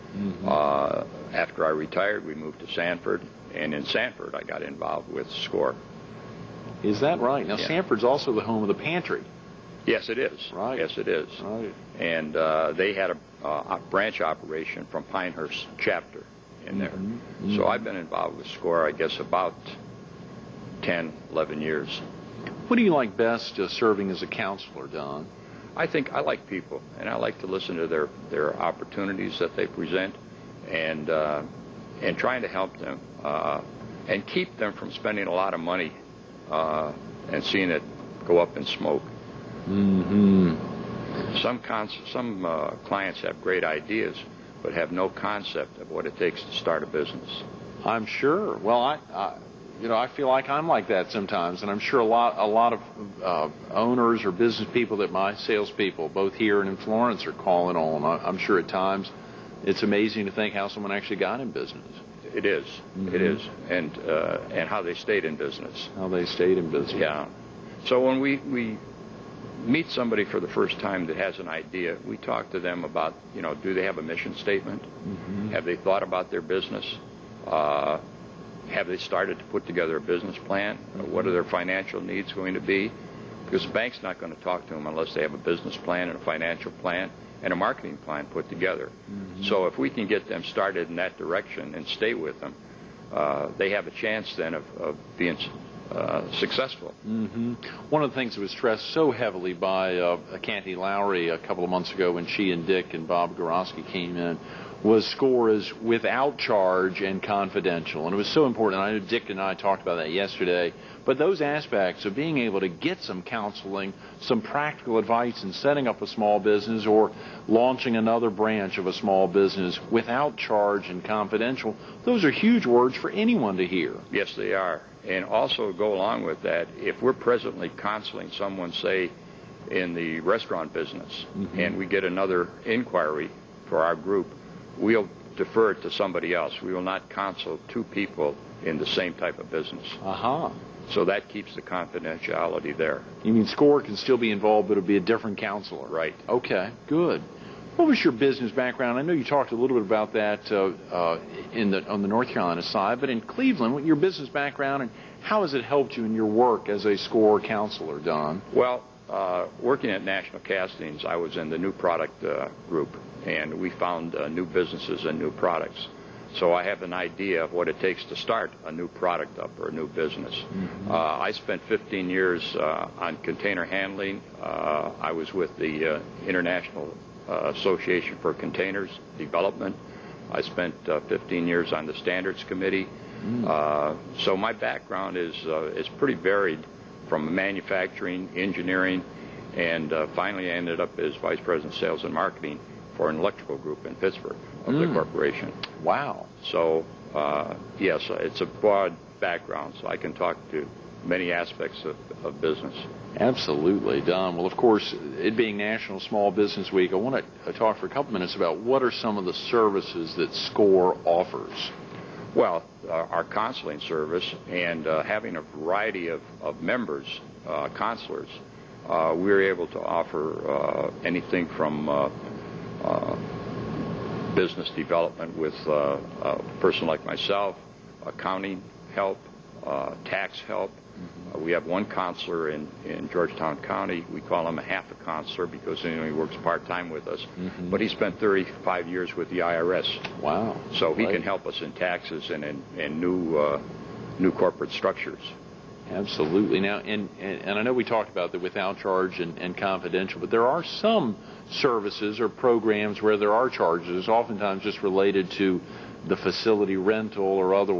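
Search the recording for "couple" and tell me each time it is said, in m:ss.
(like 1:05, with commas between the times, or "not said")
1:41, 3:27.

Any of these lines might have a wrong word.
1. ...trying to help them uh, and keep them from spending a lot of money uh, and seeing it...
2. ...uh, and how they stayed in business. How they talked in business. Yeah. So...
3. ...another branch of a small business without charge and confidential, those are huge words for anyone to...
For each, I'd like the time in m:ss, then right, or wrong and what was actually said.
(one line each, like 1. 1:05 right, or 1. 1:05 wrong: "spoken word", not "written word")
1. 0:32 right
2. 1:03 wrong: "stayed", not "talked"
3. 1:57 right.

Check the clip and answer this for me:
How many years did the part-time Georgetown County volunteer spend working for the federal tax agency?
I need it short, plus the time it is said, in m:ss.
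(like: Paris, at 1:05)
35, at 3:58.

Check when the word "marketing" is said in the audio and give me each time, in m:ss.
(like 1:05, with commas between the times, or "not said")
1:27, 3:12.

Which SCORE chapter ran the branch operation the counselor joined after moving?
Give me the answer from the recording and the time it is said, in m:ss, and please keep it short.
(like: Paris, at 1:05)
Pinehurst, at 0:15.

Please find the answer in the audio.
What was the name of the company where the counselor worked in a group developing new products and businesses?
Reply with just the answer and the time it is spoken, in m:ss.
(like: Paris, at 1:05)
National Castings, at 2:40.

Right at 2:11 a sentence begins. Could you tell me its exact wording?
and we get another inquiry for our group, we'll defer it to somebody else.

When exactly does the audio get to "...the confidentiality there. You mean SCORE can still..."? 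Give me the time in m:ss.
2:21.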